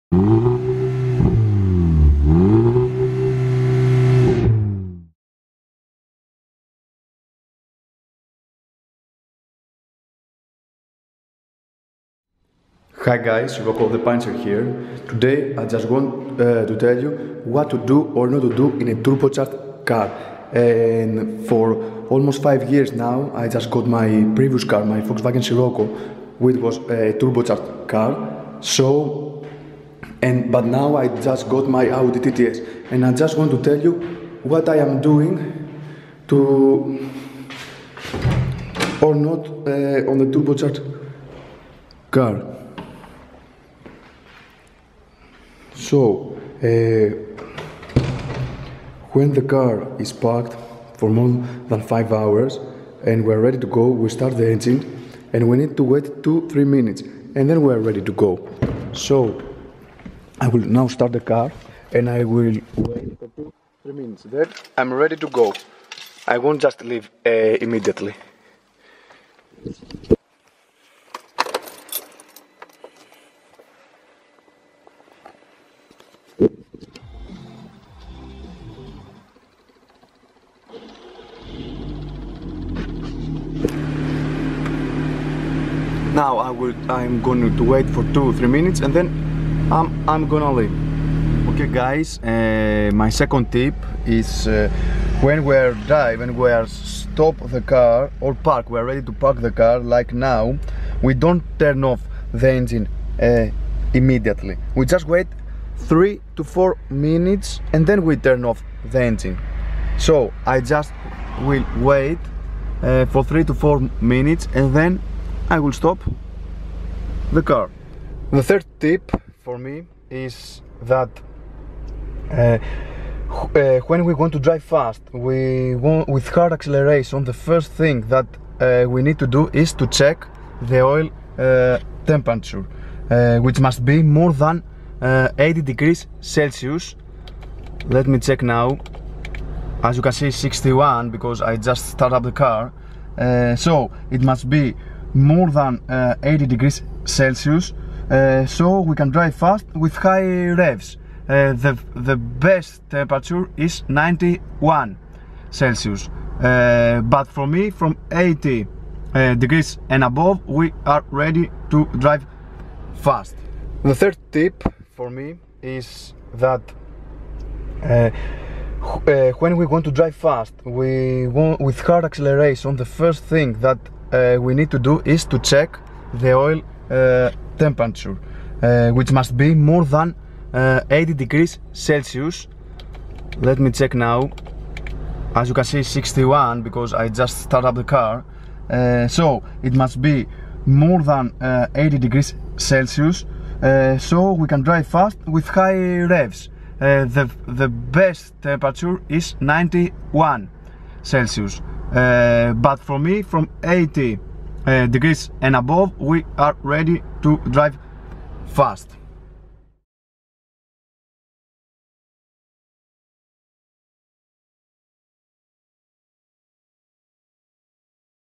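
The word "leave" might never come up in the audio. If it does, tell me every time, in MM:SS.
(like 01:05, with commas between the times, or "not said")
01:06, 01:30.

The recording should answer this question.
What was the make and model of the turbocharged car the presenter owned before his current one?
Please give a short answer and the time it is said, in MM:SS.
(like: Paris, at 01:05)
Volkswagen Scirocco, at 00:25.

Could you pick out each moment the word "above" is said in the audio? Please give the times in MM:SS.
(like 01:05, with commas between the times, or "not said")
02:40, 03:25.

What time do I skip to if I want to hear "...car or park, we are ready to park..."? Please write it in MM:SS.
01:37.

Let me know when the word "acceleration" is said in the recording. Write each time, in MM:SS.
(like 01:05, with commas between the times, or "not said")
02:06, 02:52.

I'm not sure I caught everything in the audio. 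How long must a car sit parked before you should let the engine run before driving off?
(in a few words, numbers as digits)
5 hours.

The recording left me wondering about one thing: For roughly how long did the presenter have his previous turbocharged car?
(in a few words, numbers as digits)
almost 5 years.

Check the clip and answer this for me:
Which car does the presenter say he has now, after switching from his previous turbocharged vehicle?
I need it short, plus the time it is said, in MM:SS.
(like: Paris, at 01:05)
Audi TTS, at 00:31.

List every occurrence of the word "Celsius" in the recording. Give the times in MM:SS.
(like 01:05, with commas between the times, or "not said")
02:16, 02:27, 02:35, 03:01, 03:12, 03:21.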